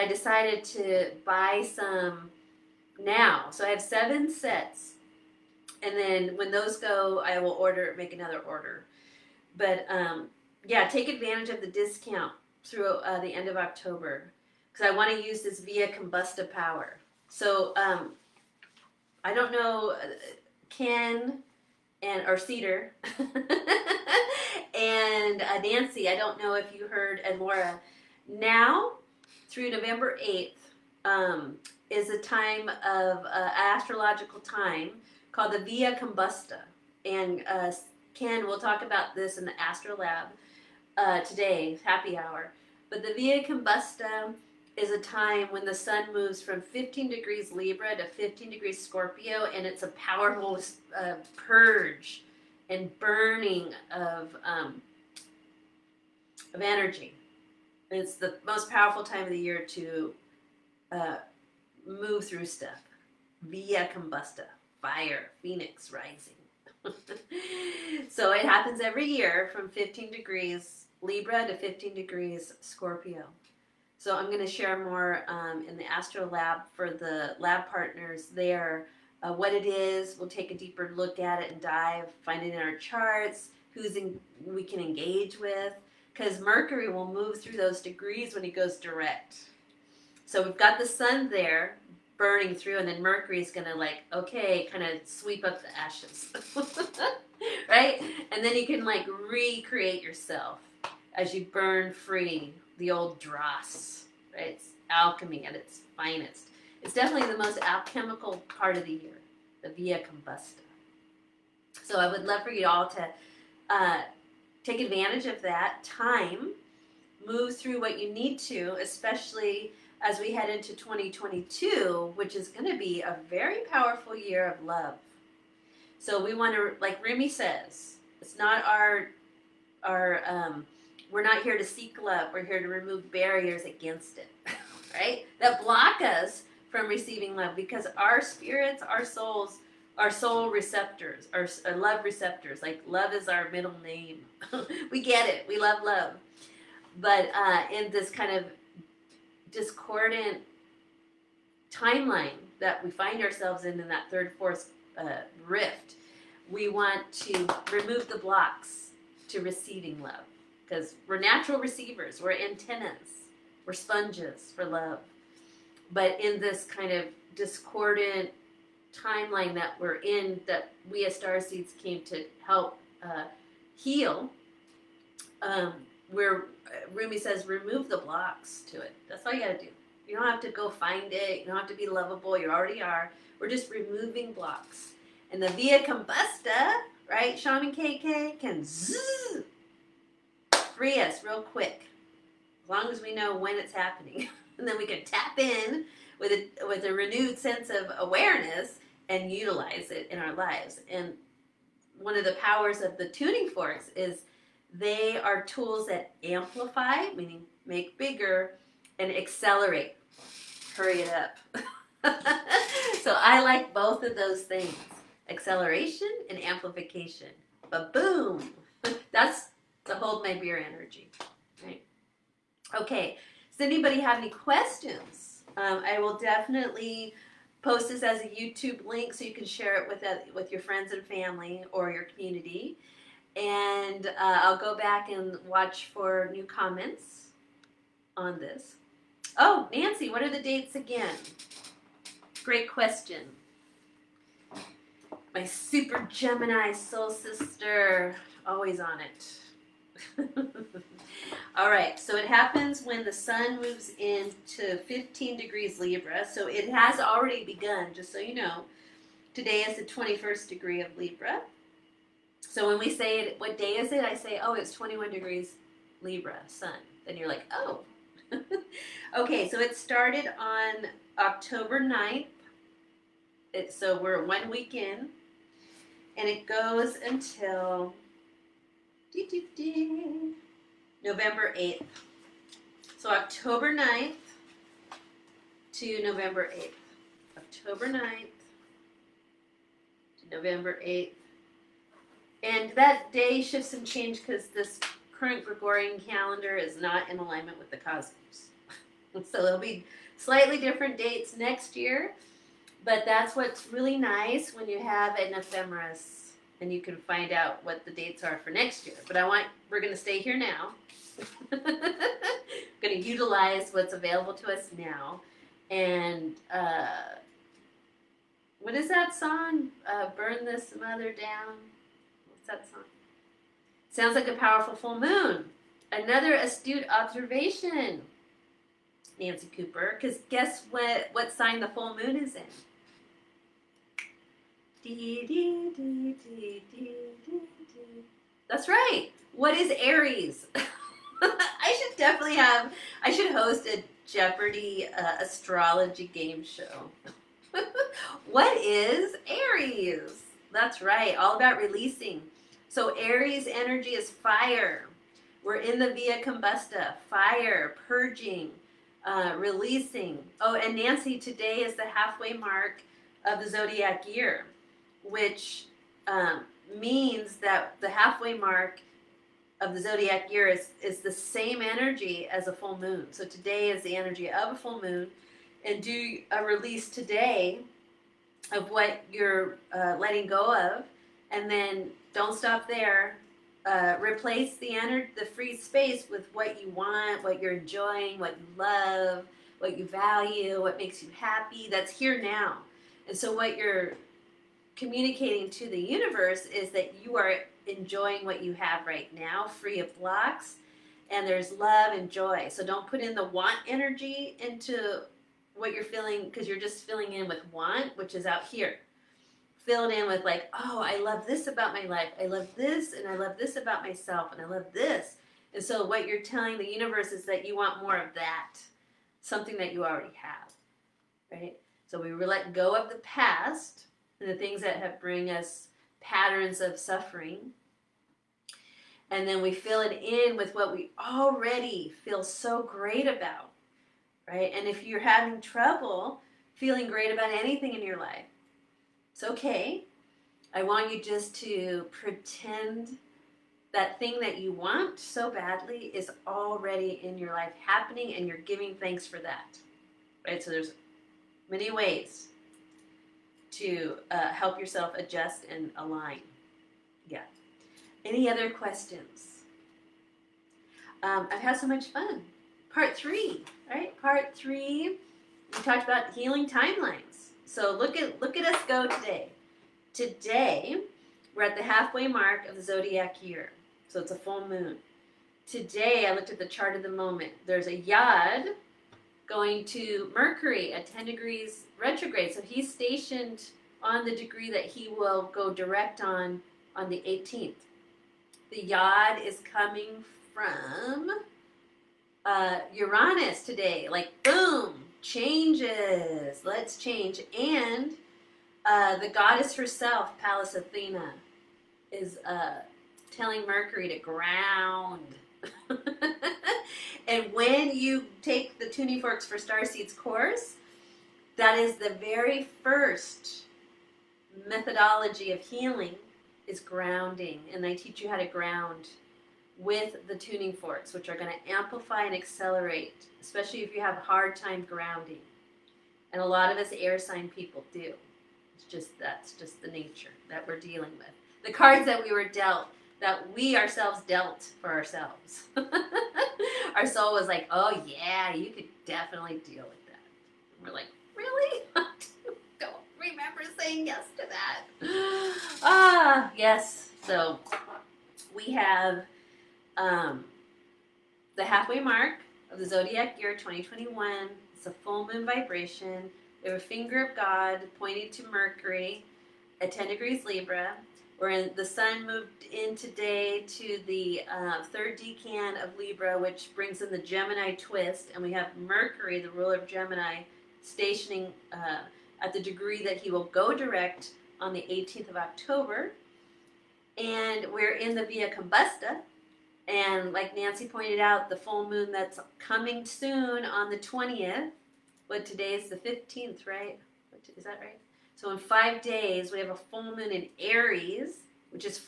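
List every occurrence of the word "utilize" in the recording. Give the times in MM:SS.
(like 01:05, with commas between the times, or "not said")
03:19, 05:12.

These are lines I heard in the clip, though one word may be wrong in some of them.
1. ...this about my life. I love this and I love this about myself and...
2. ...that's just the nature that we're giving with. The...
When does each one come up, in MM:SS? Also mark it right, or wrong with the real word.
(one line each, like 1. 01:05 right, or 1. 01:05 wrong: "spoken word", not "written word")
1. 06:51 right
2. 08:48 wrong: "dealing", not "giving".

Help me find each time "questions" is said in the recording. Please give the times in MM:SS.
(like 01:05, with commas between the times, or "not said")
03:44, 04:02, 07:38.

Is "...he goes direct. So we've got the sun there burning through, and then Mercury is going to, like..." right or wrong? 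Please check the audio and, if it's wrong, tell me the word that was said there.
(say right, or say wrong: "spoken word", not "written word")
right.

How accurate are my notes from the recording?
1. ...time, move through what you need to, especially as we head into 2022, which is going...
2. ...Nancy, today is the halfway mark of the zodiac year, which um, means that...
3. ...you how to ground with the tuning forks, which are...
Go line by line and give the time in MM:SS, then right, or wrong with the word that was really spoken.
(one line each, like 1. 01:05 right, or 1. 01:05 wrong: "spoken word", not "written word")
1. 01:55 right
2. 06:00 right
3. 08:37 right.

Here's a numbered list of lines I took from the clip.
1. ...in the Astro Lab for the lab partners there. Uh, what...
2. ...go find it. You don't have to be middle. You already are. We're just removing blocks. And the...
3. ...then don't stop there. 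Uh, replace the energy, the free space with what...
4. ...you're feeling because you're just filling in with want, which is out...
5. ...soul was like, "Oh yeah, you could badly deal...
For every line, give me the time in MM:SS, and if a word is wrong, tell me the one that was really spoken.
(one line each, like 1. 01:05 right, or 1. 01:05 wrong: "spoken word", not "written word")
1. 01:15 right
2. 03:00 wrong: "lovable", not "middle"
3. 06:21 right
4. 06:45 right
5. 08:56 wrong: "definitely", not "badly".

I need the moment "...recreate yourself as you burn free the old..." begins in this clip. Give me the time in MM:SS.
01:39.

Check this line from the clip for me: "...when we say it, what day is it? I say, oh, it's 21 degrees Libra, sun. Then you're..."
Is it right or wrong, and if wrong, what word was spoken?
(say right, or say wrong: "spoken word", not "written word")
right.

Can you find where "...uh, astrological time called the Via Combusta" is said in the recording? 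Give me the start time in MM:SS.
00:33.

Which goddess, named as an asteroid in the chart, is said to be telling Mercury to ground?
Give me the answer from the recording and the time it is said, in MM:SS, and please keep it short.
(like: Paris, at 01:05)
Pallas Athena, at 08:20.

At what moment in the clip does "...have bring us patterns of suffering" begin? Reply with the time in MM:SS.
07:04.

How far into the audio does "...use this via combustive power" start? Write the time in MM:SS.
00:15.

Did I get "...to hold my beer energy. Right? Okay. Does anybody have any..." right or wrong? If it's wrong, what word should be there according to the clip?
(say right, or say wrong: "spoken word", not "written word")
right.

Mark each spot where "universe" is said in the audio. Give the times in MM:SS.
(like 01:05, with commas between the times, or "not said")
06:35, 06:56.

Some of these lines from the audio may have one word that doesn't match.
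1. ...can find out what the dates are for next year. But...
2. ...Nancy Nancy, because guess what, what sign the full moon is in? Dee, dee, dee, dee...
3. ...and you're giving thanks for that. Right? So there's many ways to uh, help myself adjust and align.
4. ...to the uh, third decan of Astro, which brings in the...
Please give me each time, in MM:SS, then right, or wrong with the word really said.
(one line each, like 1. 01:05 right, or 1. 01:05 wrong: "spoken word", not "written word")
1. 05:06 right
2. 05:29 wrong: "Cooper", not "Nancy"
3. 07:28 wrong: "yourself", not "myself"
4. 09:23 wrong: "Libra", not "Astro".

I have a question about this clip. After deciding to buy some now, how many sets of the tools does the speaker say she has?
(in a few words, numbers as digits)
7.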